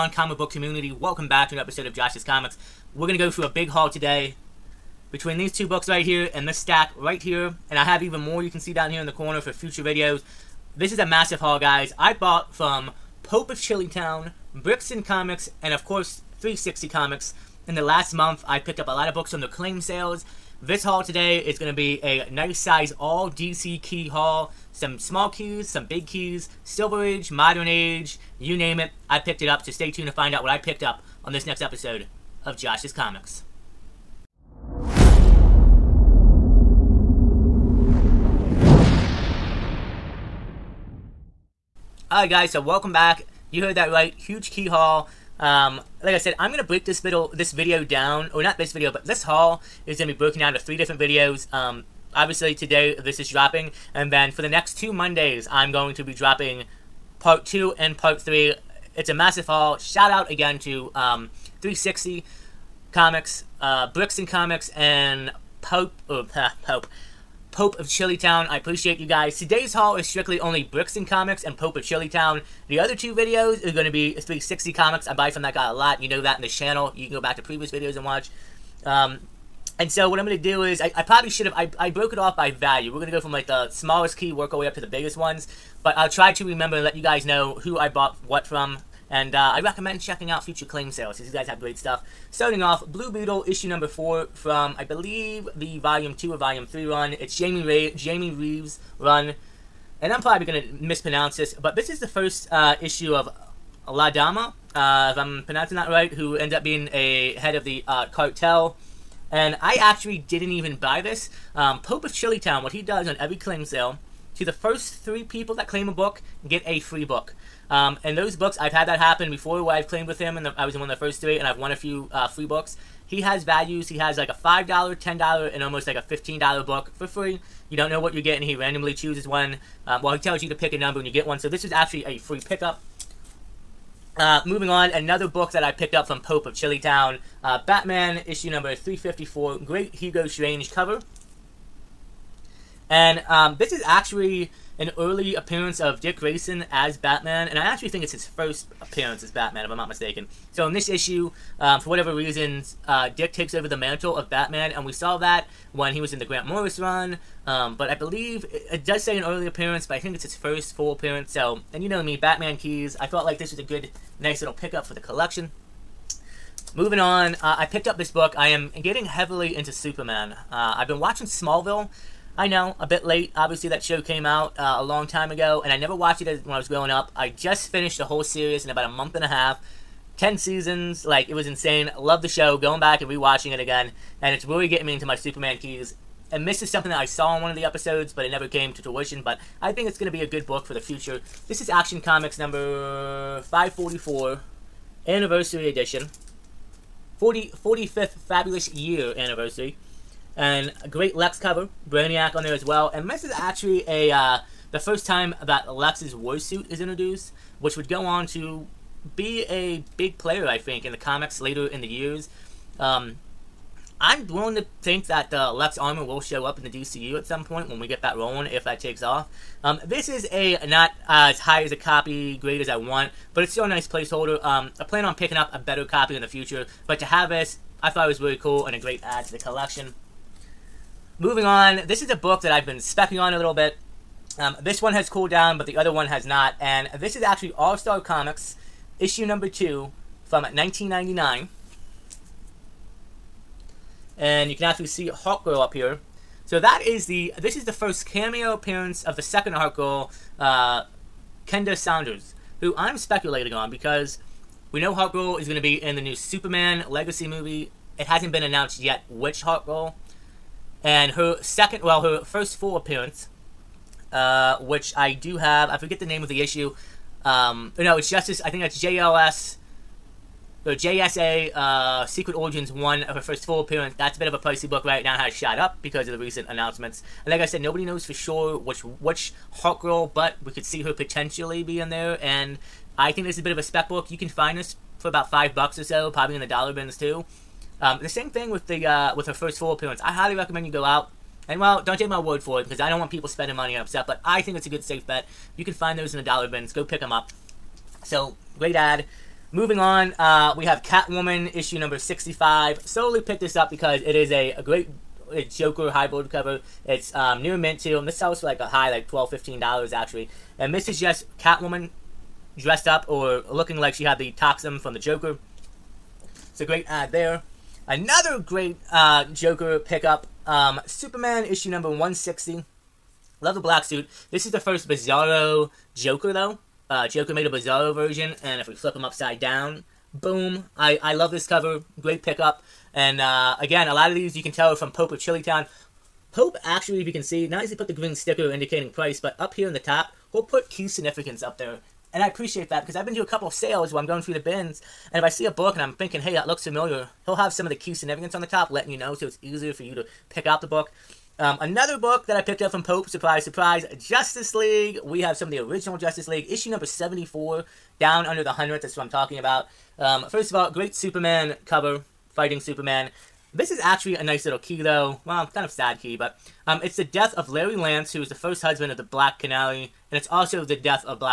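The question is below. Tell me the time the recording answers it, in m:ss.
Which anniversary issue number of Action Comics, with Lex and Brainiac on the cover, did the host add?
3:13.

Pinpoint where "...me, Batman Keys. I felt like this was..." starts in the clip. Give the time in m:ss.
2:42.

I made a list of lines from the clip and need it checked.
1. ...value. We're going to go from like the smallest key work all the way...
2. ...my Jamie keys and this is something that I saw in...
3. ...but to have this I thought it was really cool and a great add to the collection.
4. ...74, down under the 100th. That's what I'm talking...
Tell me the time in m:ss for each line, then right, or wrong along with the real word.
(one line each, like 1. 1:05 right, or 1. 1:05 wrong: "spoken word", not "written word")
1. 1:22 right
2. 3:05 wrong: "Superman", not "Jamie"
3. 3:46 right
4. 5:56 right.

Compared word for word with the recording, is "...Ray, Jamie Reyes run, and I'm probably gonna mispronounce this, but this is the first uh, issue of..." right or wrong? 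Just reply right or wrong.
right.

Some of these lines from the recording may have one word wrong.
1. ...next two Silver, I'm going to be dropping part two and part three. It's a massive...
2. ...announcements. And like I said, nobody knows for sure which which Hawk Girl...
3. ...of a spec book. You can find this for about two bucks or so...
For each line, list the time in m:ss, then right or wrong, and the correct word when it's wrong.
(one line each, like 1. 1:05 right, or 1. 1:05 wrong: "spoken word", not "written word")
1. 0:54 wrong: "Mondays", not "Silver"
2. 4:36 right
3. 4:43 wrong: "five", not "two".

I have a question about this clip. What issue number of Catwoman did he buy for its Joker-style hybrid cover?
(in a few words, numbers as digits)
65.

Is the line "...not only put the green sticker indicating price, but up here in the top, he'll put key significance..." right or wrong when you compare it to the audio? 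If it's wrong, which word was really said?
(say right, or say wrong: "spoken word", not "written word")
right.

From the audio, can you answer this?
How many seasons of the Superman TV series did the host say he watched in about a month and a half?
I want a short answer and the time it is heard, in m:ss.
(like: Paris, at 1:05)
10, at 3:00.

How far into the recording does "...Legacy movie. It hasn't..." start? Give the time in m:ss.
4:16.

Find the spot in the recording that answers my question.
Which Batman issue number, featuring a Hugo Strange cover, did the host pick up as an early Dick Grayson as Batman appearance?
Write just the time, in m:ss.
2:18.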